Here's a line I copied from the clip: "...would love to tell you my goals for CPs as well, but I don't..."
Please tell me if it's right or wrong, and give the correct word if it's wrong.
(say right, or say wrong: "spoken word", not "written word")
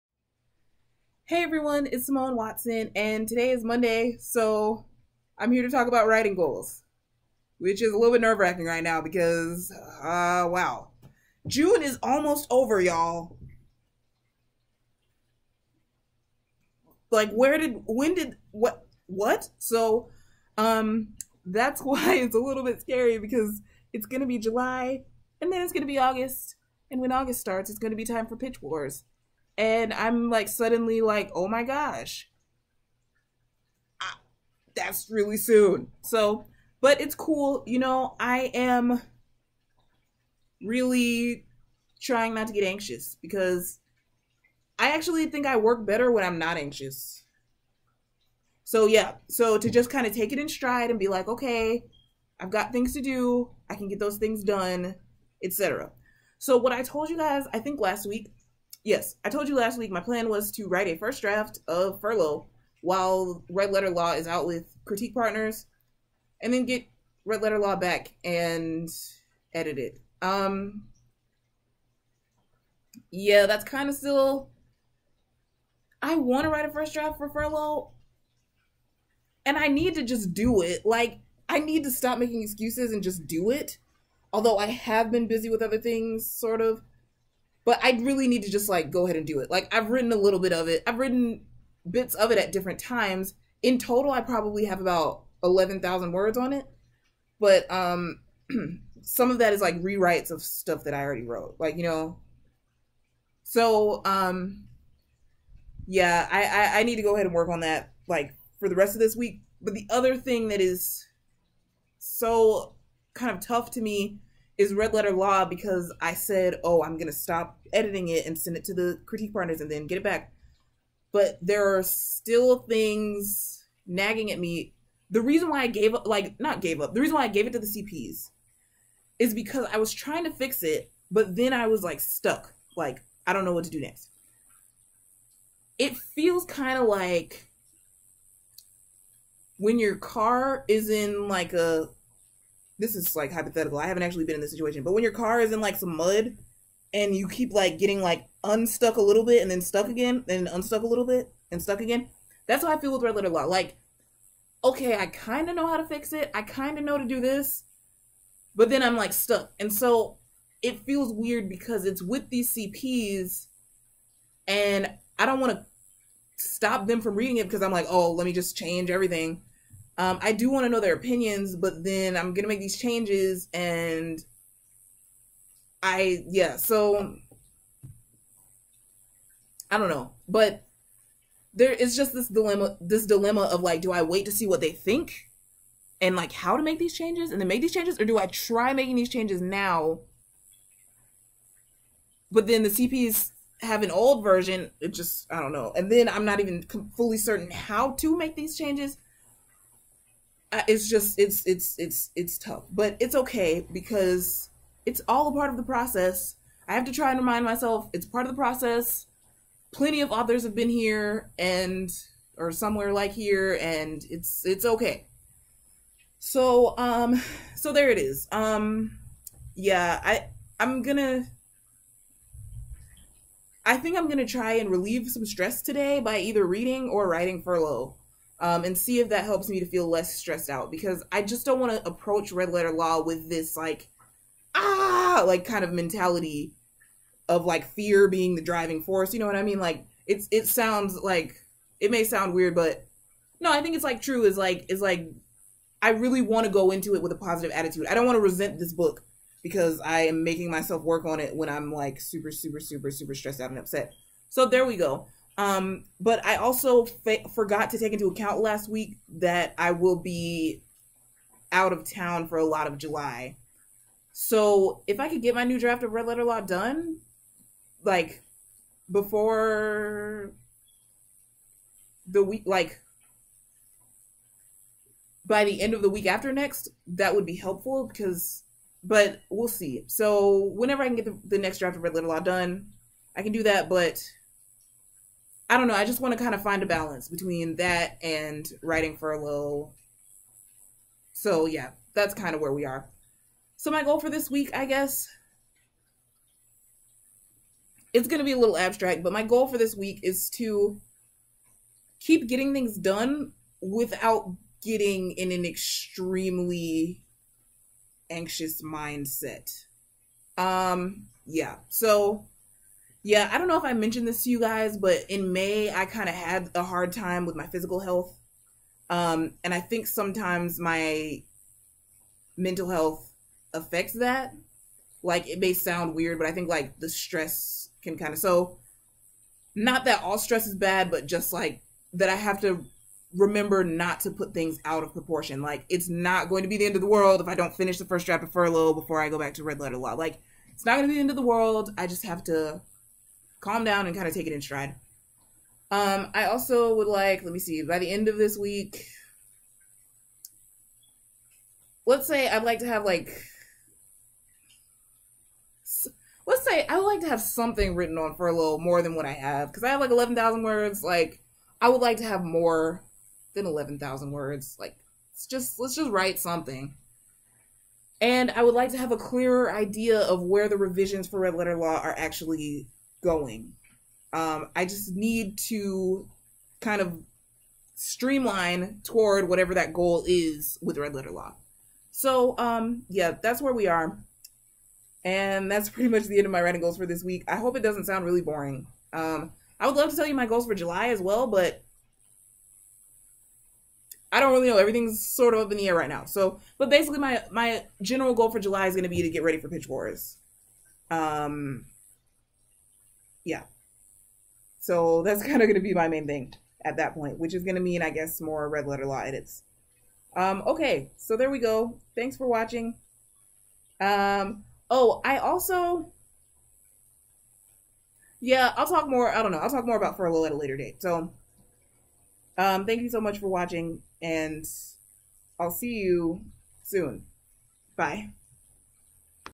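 wrong: "July", not "CPs".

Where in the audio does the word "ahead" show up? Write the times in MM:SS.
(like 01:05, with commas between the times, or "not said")
01:29, 01:47.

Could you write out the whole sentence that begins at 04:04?
Is like is like I really want to go into it with a positive attitude.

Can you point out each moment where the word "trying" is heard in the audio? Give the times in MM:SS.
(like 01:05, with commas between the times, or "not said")
00:42, 02:09.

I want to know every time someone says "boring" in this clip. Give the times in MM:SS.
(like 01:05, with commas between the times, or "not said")
06:28.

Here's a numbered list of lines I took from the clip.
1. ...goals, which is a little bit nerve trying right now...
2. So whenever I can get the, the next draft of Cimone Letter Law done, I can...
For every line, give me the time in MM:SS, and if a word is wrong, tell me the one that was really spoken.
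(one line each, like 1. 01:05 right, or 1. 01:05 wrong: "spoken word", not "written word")
1. 00:06 wrong: "wracking", not "trying"
2. 04:39 wrong: "Red", not "Cimone".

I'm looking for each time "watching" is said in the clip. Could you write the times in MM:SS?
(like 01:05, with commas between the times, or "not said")
06:52, 07:03.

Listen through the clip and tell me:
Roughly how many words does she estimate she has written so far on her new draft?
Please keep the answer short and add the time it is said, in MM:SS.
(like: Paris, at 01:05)
11,000, at 01:34.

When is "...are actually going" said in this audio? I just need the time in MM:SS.
06:11.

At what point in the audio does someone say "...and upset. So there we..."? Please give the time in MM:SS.
04:13.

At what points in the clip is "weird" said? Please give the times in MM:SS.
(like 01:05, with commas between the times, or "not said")
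02:41, 04:02, 05:25.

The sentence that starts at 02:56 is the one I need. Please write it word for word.
So I don't know, but there is just this dilemma.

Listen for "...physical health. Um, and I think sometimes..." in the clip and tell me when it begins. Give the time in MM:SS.
05:17.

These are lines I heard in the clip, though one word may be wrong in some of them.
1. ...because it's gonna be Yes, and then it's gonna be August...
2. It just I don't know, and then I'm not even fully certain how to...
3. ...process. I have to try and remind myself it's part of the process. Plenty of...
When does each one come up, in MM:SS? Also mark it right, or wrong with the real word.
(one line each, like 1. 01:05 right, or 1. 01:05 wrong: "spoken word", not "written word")
1. 00:23 wrong: "July", not "Yes"
2. 03:14 right
3. 03:25 right.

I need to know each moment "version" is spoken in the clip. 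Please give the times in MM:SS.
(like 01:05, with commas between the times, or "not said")
03:14.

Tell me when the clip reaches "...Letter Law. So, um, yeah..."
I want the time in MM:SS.
06:20.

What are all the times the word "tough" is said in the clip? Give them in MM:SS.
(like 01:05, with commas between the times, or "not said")
01:53, 03:22.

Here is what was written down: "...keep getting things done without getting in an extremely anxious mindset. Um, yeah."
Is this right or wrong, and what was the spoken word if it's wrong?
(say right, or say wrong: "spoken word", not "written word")
right.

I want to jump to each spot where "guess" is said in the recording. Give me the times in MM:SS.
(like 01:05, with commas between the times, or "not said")
04:54, 06:47.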